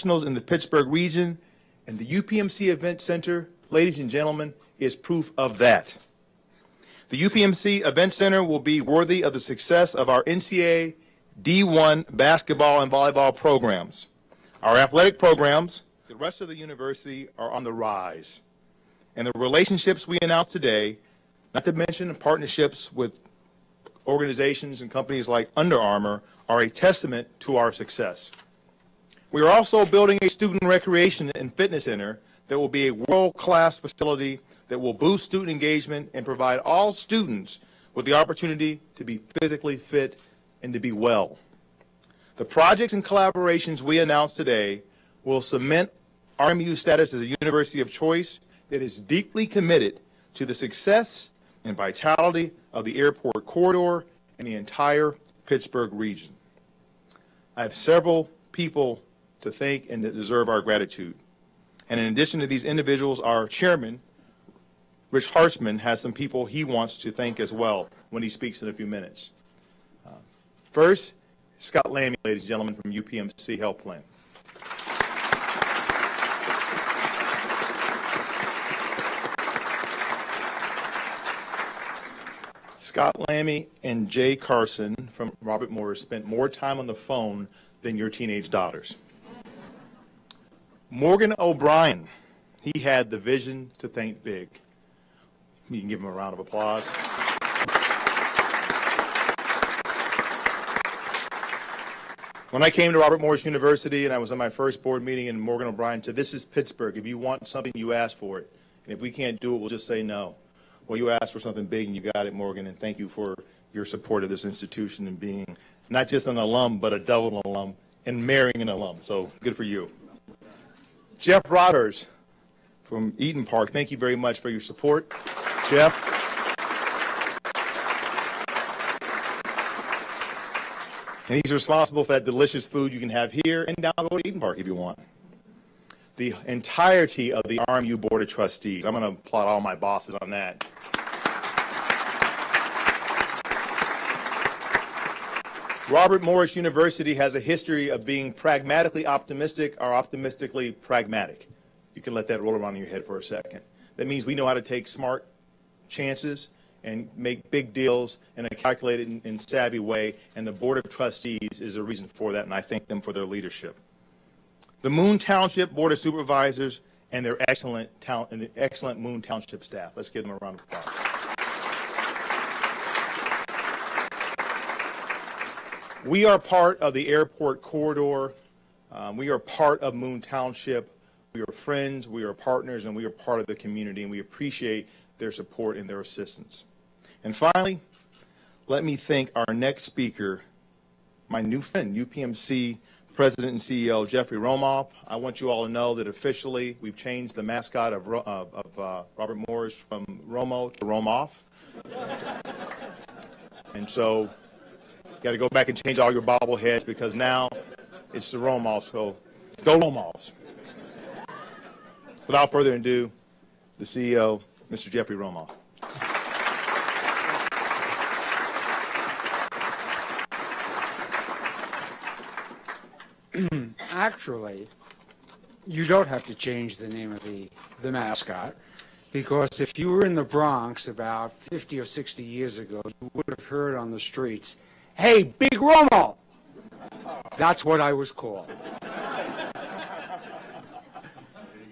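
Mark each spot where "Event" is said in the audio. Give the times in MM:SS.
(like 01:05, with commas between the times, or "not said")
00:02, 00:07.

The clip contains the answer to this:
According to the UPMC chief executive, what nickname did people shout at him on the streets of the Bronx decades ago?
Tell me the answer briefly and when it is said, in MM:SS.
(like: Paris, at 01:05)
Big Romo, at 03:55.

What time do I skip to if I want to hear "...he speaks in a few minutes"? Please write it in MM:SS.
01:08.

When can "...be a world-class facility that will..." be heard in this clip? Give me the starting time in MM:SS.
00:32.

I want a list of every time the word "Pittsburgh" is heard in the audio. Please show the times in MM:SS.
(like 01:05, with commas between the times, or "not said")
00:00, 00:55, 01:46.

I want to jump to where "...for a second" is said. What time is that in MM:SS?
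02:33.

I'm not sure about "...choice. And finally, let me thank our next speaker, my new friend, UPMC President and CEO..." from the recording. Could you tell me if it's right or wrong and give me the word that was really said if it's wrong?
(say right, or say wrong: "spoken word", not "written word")
wrong: "assistance", not "choice".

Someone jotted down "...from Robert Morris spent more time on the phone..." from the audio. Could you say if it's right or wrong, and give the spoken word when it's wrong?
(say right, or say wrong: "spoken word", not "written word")
right.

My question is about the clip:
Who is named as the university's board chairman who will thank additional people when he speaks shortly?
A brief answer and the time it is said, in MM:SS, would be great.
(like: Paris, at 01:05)
Rich Harshman, at 01:05.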